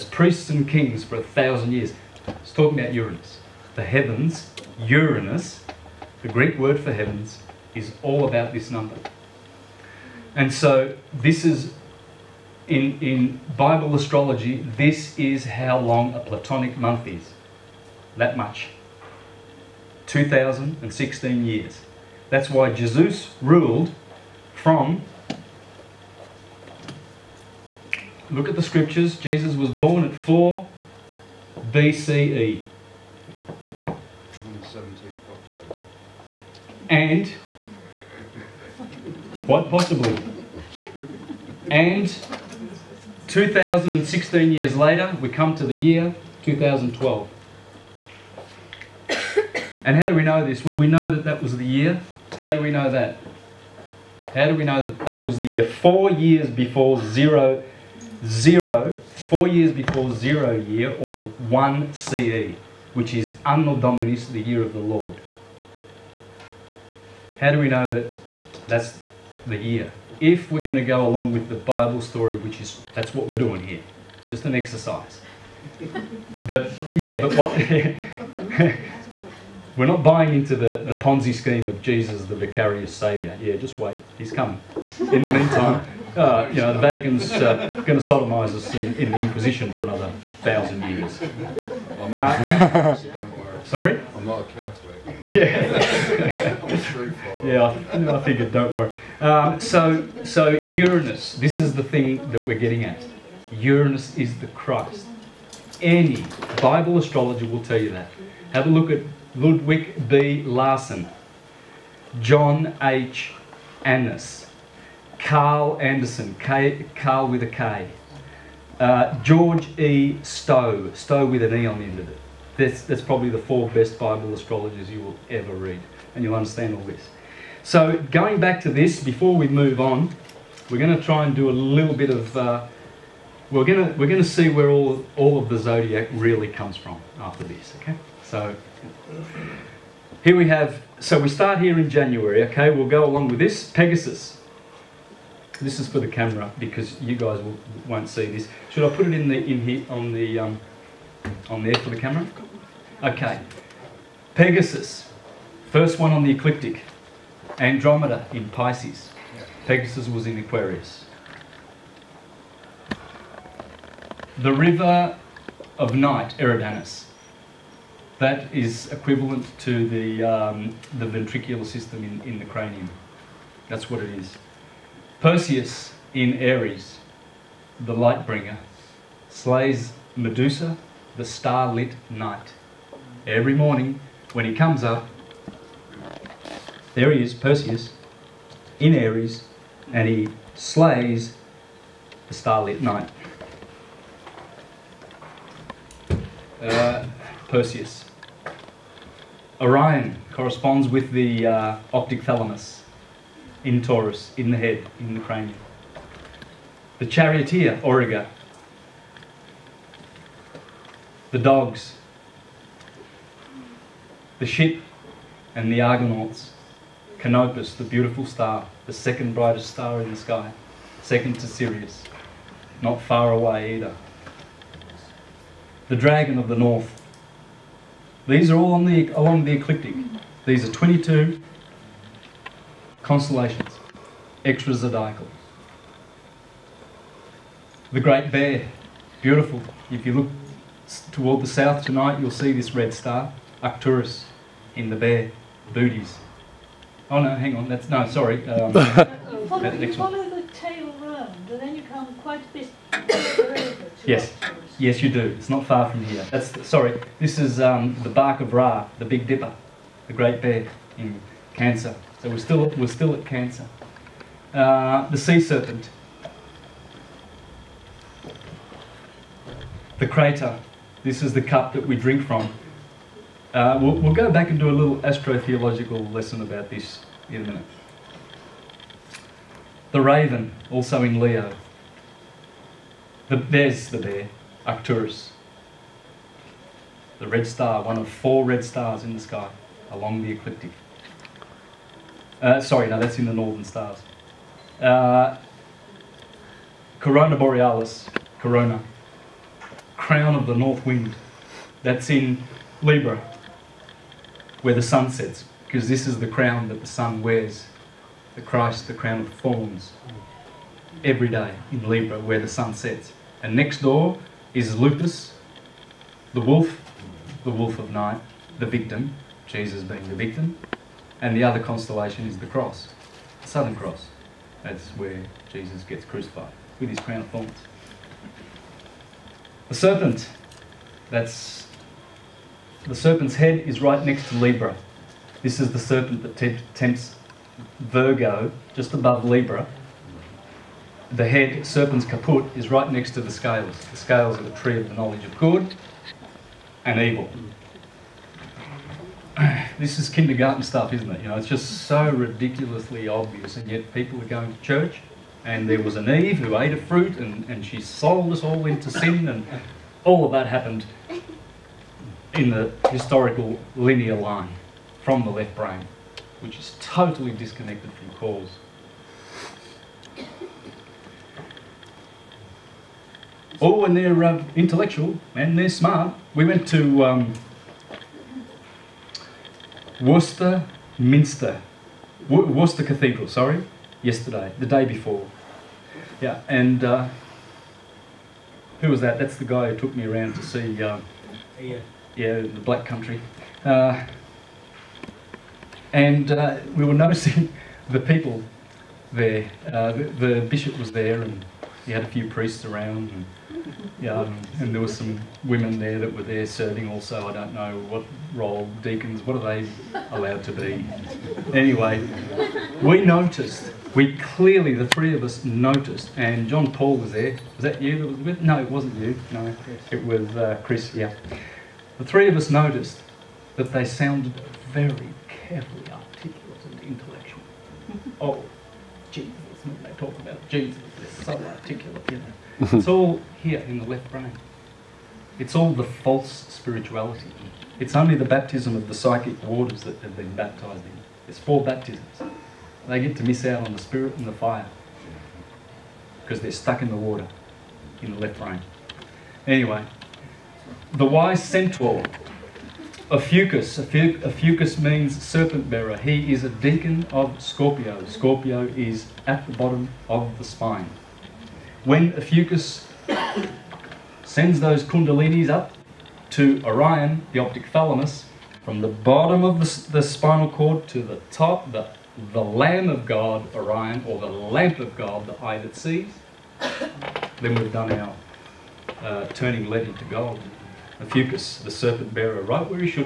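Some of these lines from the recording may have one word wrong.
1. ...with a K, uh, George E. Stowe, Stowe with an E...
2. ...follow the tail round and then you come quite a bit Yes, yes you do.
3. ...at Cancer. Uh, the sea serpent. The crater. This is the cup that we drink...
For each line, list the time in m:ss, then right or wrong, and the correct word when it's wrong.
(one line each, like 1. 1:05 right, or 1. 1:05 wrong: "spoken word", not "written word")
1. 1:57 right
2. 4:09 right
3. 4:23 right.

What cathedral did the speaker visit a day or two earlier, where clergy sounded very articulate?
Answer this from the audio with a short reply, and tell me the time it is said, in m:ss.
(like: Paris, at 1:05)
Worcester Cathedral, at 6:22.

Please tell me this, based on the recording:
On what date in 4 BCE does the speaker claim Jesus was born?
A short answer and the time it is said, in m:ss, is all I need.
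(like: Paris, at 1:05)
17 October, at 0:34.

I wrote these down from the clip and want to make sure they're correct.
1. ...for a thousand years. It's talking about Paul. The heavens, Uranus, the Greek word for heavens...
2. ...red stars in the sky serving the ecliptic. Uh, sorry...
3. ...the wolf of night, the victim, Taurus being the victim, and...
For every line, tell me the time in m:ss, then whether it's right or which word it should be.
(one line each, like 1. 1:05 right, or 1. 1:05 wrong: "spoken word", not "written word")
1. 0:01 wrong: "Uranus", not "Paul"
2. 4:48 wrong: "along", not "serving"
3. 5:17 wrong: "Jesus", not "Taurus".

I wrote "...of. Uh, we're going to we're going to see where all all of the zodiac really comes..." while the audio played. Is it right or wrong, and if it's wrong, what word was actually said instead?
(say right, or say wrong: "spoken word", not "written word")
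right.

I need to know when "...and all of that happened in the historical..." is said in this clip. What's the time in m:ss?
5:59.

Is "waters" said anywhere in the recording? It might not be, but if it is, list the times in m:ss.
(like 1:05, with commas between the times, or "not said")
7:19, 7:26.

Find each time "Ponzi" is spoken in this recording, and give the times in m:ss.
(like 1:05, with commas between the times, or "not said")
1:20.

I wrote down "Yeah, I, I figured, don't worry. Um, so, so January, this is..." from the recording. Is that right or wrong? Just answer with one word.
wrong.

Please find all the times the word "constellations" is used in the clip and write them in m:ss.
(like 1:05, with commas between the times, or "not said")
3:53, 5:21.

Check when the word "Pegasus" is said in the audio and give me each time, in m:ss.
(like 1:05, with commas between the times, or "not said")
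2:23, 2:34, 2:39.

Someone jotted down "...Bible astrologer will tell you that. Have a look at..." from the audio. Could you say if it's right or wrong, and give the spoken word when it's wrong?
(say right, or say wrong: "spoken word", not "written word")
right.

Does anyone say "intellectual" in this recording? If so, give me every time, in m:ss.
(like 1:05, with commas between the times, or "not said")
6:14, 7:06.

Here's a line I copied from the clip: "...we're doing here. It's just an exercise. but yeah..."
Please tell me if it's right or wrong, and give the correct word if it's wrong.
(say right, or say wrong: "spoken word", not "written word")
right.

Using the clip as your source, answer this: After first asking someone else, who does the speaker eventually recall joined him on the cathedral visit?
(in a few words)
Chris.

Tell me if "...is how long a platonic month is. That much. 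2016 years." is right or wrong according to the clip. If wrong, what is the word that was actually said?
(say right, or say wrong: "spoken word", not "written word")
right.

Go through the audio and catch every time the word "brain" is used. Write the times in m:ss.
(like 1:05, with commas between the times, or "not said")
6:05, 7:14, 7:28.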